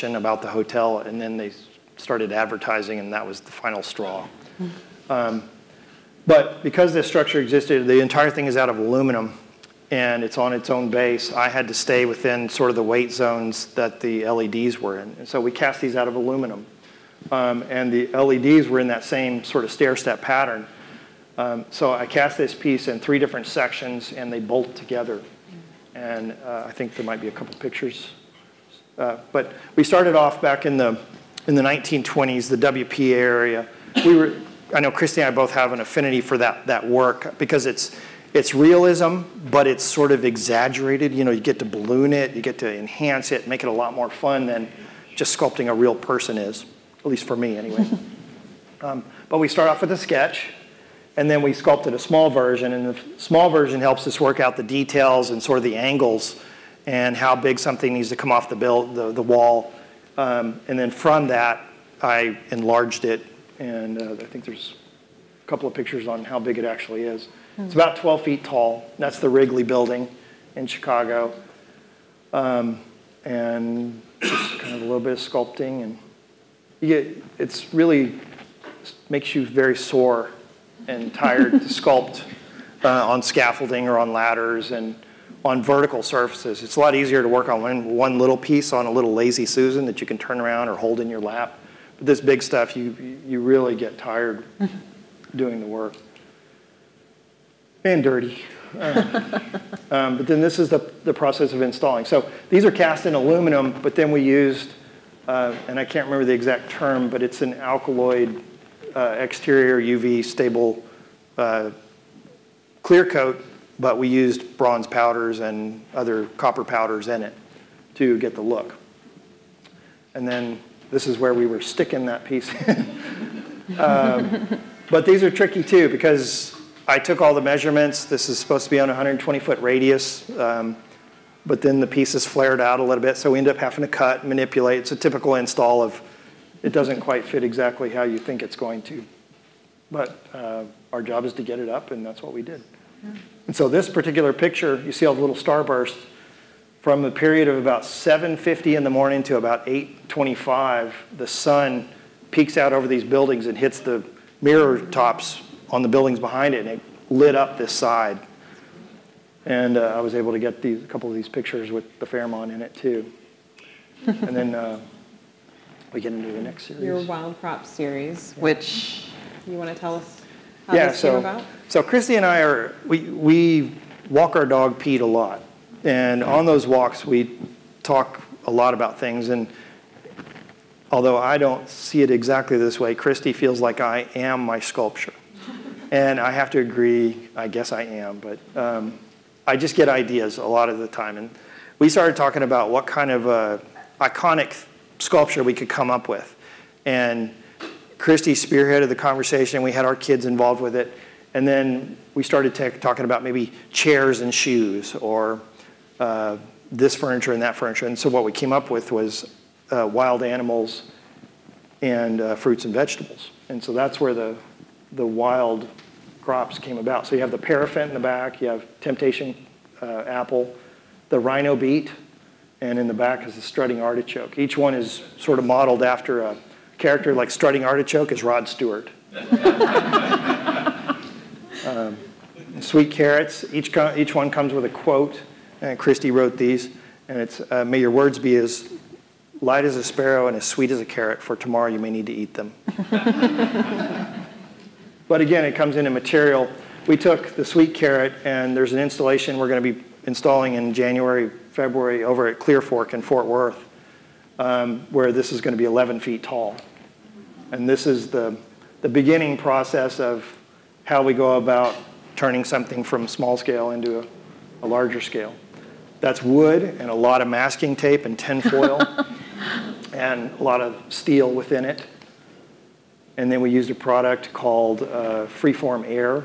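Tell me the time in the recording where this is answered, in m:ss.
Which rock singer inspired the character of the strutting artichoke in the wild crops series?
3:48.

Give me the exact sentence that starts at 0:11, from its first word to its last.
I had to stay within sort of the weight zones that the LEDs were in.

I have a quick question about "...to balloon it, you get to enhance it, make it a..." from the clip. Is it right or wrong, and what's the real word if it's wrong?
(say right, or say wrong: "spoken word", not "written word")
right.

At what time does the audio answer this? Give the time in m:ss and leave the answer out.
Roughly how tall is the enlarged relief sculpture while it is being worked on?
1:07.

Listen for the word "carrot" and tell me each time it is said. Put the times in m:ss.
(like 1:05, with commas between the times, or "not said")
3:52, 4:00, 4:07.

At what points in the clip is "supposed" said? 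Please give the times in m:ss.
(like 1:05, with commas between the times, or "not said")
2:08.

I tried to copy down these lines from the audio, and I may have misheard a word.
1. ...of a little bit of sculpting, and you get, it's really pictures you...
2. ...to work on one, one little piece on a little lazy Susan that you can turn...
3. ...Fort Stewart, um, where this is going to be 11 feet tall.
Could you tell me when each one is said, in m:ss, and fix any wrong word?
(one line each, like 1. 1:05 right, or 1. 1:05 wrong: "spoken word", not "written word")
1. 1:14 wrong: "makes", not "pictures"
2. 1:27 right
3. 4:13 wrong: "Worth", not "Stewart".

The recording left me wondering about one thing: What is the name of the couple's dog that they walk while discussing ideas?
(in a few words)
Pete.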